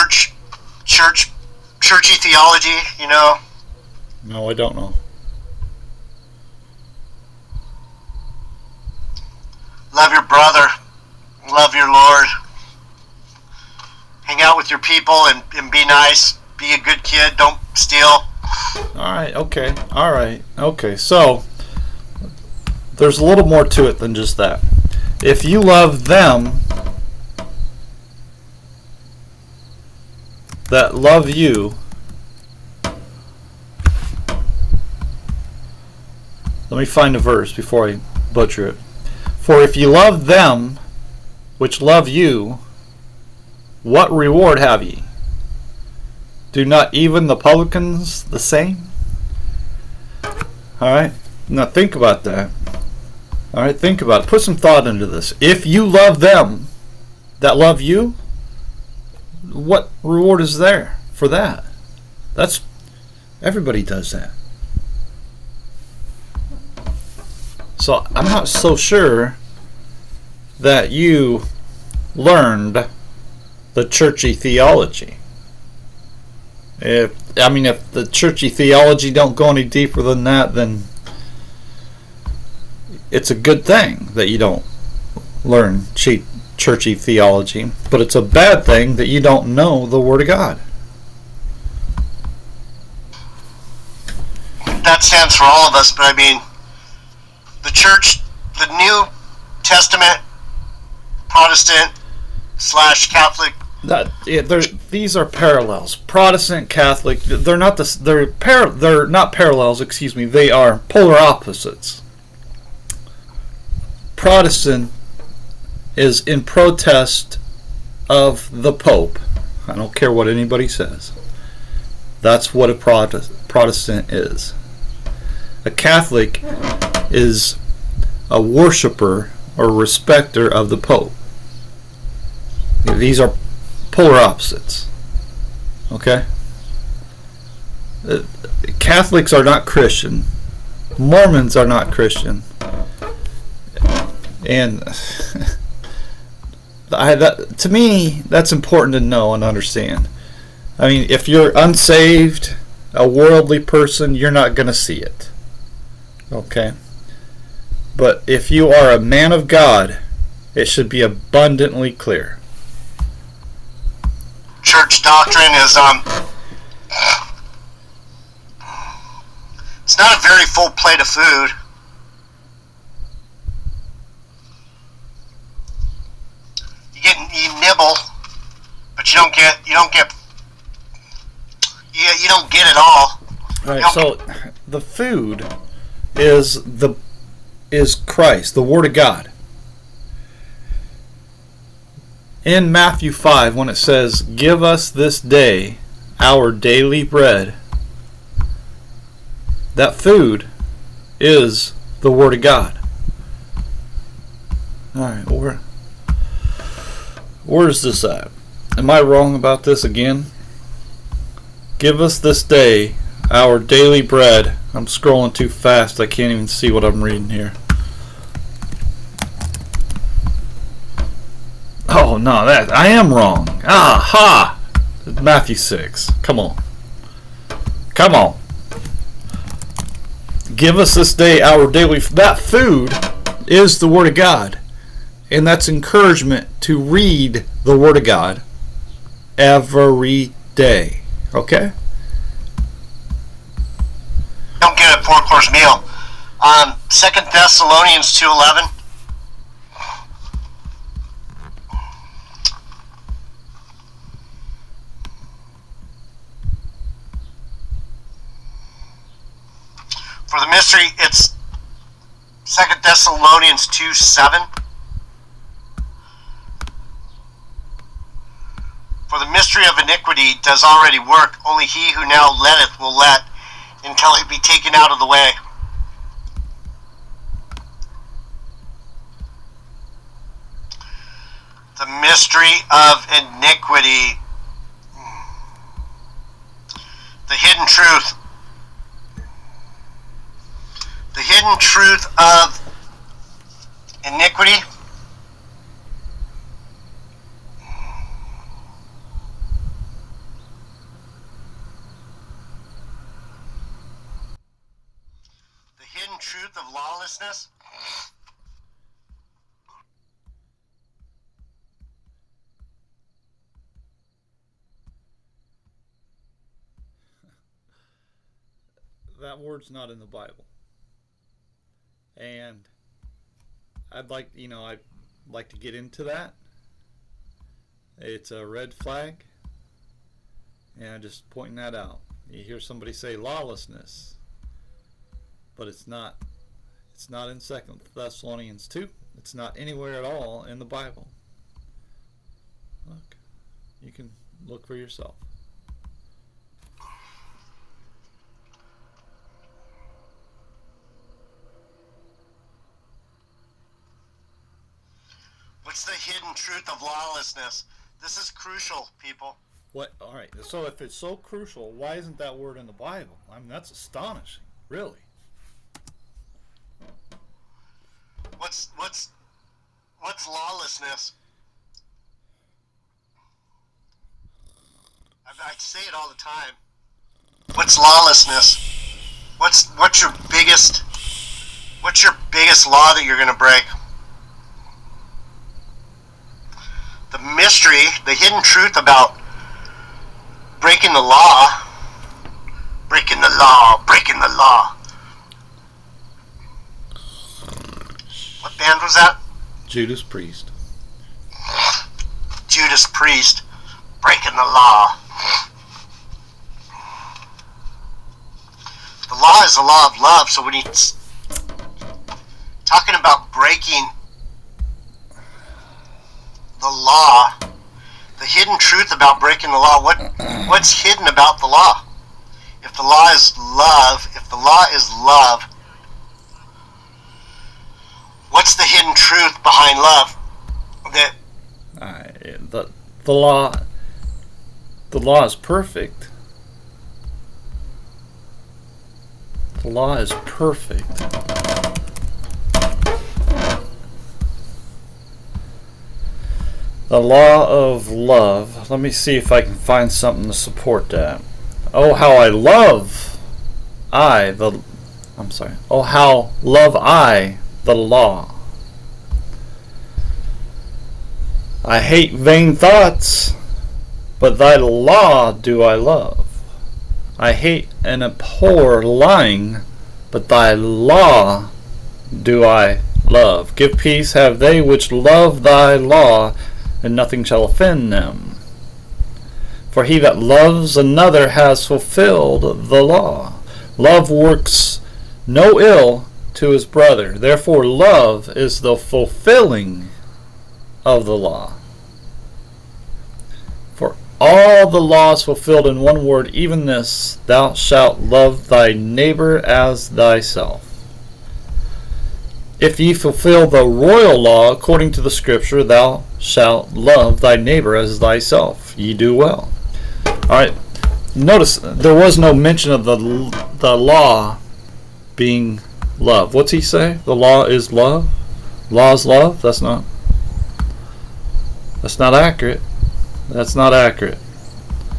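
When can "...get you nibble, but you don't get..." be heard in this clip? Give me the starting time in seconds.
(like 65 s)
177 s.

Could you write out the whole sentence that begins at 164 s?
Church doctrine is um it's not a very full plate of food.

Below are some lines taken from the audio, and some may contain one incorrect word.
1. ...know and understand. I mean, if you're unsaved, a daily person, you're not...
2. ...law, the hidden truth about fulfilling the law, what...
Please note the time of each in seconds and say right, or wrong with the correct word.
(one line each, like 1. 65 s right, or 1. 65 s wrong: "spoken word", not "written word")
1. 148 s wrong: "worldly", not "daily"
2. 416 s wrong: "breaking", not "fulfilling".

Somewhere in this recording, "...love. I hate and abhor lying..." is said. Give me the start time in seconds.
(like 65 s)
465 s.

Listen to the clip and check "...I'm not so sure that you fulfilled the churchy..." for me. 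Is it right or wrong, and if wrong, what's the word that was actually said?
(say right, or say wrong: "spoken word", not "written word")
wrong: "learned", not "fulfilled".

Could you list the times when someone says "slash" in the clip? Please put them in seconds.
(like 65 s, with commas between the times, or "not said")
102 s.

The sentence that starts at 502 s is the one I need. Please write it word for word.
If ye fulfill the royal law according to the scripture, Thou shalt love thy neighbor as thyself.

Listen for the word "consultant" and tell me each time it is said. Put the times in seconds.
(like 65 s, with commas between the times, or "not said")
not said.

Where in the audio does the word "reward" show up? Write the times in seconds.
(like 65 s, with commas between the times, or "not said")
44 s, 60 s.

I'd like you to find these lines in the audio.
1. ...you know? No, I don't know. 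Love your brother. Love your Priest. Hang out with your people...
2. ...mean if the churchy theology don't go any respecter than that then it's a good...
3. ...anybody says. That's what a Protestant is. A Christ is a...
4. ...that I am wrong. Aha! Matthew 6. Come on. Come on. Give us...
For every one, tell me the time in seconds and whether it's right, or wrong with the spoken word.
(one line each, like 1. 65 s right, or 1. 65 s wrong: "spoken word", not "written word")
1. 2 s wrong: "Lord", not "Priest"
2. 77 s wrong: "deeper", not "respecter"
3. 120 s wrong: "Catholic", not "Christ"
4. 222 s right.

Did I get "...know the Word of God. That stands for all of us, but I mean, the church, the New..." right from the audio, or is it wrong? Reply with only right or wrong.
right.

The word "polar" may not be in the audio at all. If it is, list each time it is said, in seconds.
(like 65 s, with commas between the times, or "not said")
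110 s, 133 s.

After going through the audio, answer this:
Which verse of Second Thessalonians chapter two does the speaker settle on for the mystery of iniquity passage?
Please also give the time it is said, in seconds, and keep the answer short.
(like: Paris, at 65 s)
2 Thessalonians 2:7, at 262 s.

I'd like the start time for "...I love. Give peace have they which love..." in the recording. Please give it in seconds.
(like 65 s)
472 s.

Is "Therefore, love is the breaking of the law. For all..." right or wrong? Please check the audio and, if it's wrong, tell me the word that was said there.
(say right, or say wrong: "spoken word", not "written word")
wrong: "fulfilling", not "breaking".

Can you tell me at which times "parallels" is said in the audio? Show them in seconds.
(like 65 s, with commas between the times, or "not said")
105 s, 109 s.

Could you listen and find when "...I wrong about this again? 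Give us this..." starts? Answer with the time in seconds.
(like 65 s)
208 s.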